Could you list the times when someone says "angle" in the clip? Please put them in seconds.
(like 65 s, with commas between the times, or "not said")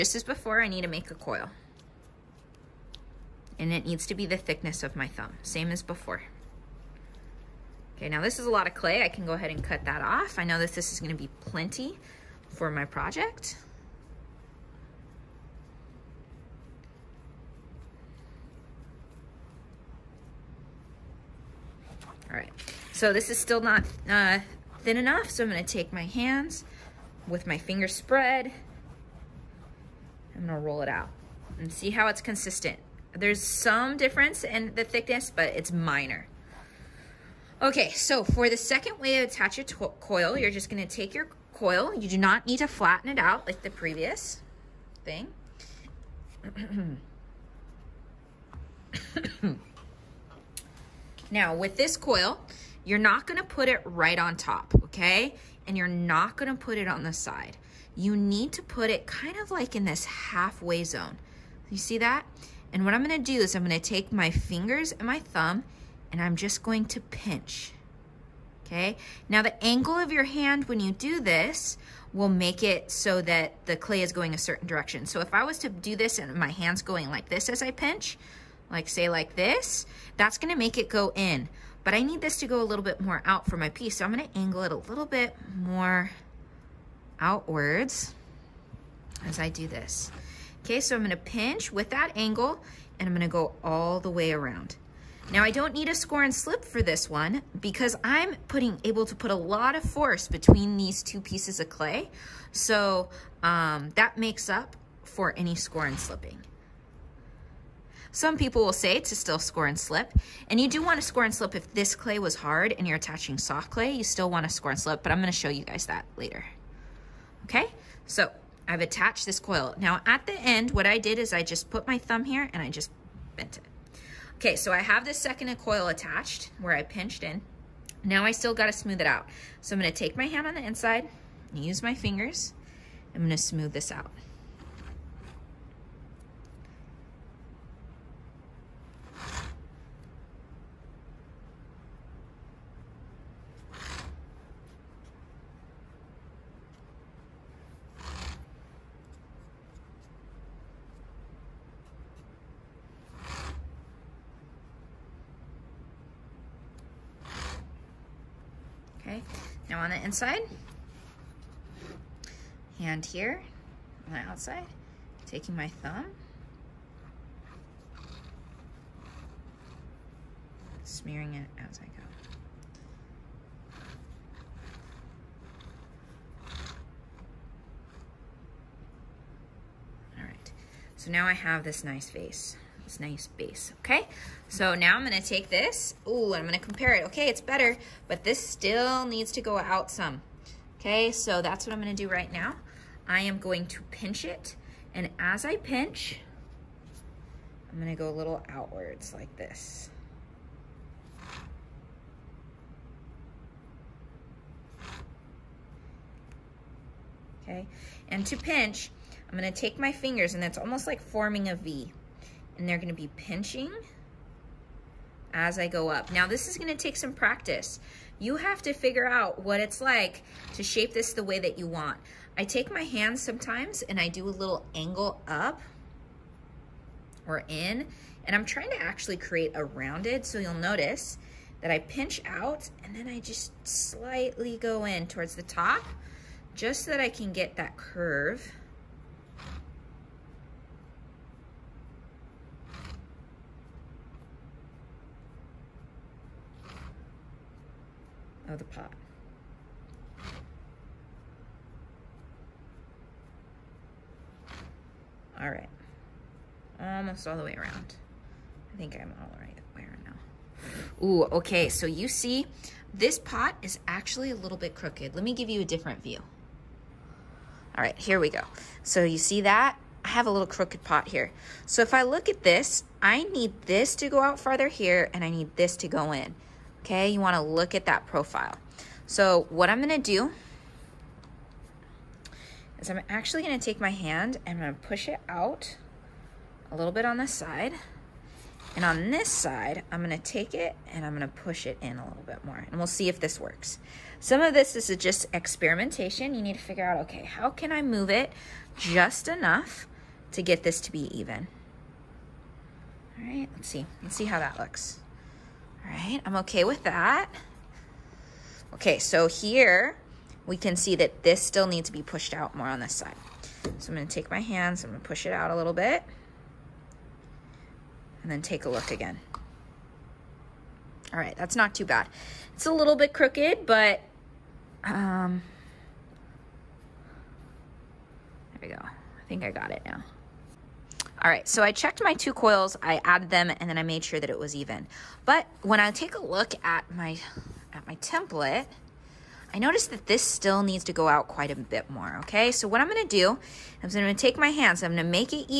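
69 s, 84 s, 92 s, 224 s.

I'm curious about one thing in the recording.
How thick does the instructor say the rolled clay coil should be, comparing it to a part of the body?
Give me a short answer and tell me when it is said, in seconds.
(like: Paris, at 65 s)
Thickness of my thumb, at 4 s.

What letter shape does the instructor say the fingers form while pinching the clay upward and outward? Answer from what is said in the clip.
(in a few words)
V.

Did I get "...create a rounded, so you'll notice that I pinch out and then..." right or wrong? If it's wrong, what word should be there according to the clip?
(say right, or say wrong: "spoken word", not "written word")
right.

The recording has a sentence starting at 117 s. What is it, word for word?
Okay, so I've attached this coil.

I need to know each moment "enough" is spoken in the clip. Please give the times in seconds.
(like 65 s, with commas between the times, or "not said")
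24 s, 299 s.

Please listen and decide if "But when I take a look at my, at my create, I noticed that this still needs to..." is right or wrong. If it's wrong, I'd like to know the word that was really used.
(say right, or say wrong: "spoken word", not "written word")
wrong: "template", not "create".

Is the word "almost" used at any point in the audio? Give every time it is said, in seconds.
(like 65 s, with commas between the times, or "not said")
210 s, 256 s.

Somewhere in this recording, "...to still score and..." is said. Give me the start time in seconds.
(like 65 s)
108 s.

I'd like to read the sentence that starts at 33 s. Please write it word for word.
There's some difference in the thickness, but it's minor.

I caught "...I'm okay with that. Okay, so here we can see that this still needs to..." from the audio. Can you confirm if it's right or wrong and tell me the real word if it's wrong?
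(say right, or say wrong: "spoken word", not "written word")
right.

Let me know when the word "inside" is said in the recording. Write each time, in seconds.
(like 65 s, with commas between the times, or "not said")
130 s, 160 s.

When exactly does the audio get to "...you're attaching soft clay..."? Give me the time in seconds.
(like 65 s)
112 s.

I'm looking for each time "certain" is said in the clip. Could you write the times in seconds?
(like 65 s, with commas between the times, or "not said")
74 s.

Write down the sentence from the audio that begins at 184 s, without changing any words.
So now I'm gonna take this, ooh, I'm gonna compare it.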